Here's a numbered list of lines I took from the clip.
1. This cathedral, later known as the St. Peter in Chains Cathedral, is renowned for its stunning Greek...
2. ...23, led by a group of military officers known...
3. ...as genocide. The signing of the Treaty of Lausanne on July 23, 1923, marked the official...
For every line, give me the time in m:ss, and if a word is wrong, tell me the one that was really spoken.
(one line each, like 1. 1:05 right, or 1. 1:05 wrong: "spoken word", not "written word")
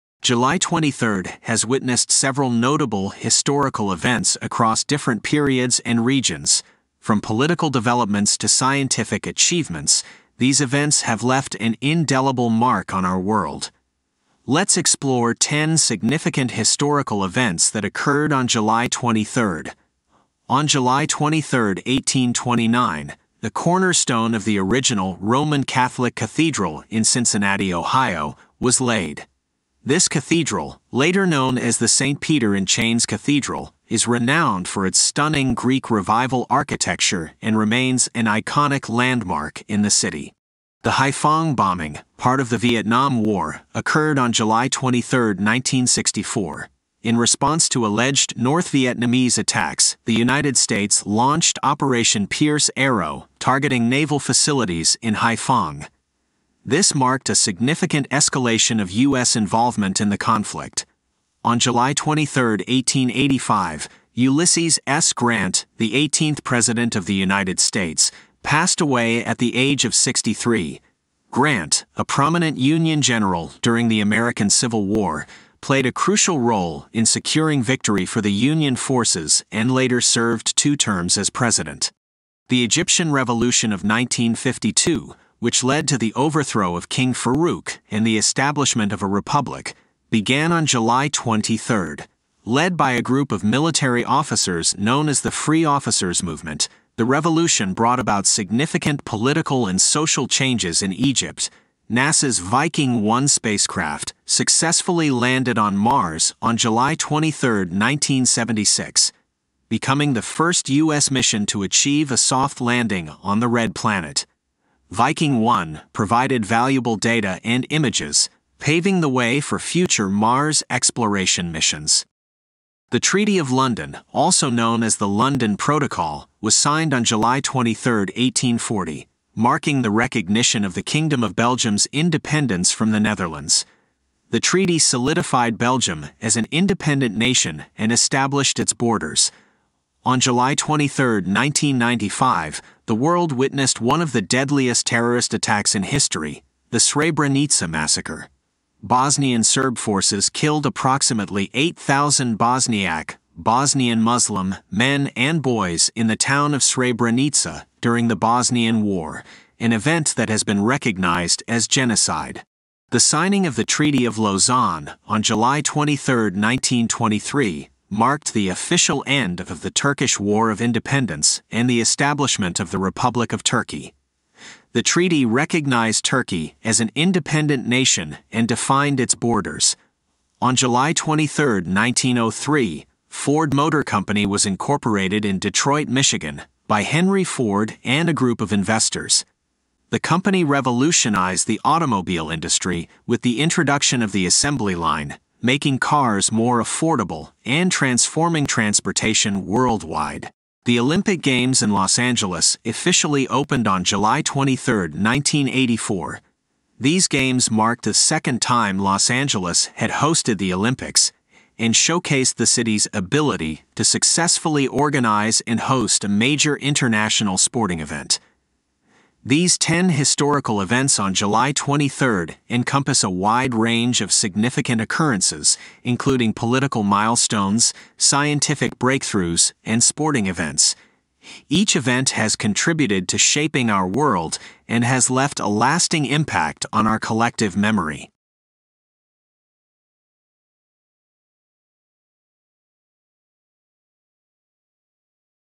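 1. 0:29 right
2. 1:31 right
3. 2:41 right.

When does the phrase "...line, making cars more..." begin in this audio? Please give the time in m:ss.
3:14.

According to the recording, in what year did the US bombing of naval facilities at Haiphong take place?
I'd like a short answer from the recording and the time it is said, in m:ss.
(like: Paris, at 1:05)
1964, at 0:45.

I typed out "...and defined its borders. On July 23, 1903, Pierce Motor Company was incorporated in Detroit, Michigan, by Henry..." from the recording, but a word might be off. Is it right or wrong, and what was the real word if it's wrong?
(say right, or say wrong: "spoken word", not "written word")
wrong: "Ford", not "Pierce".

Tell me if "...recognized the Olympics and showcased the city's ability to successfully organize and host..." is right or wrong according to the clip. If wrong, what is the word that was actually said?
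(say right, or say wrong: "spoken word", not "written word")
wrong: "hosted", not "recognized".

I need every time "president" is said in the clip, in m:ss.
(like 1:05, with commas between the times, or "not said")
1:06, 1:21.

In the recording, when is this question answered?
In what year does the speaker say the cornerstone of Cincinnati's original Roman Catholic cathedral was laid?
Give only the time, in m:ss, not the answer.
0:21.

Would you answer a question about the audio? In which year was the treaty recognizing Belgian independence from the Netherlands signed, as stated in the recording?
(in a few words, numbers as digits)
1840.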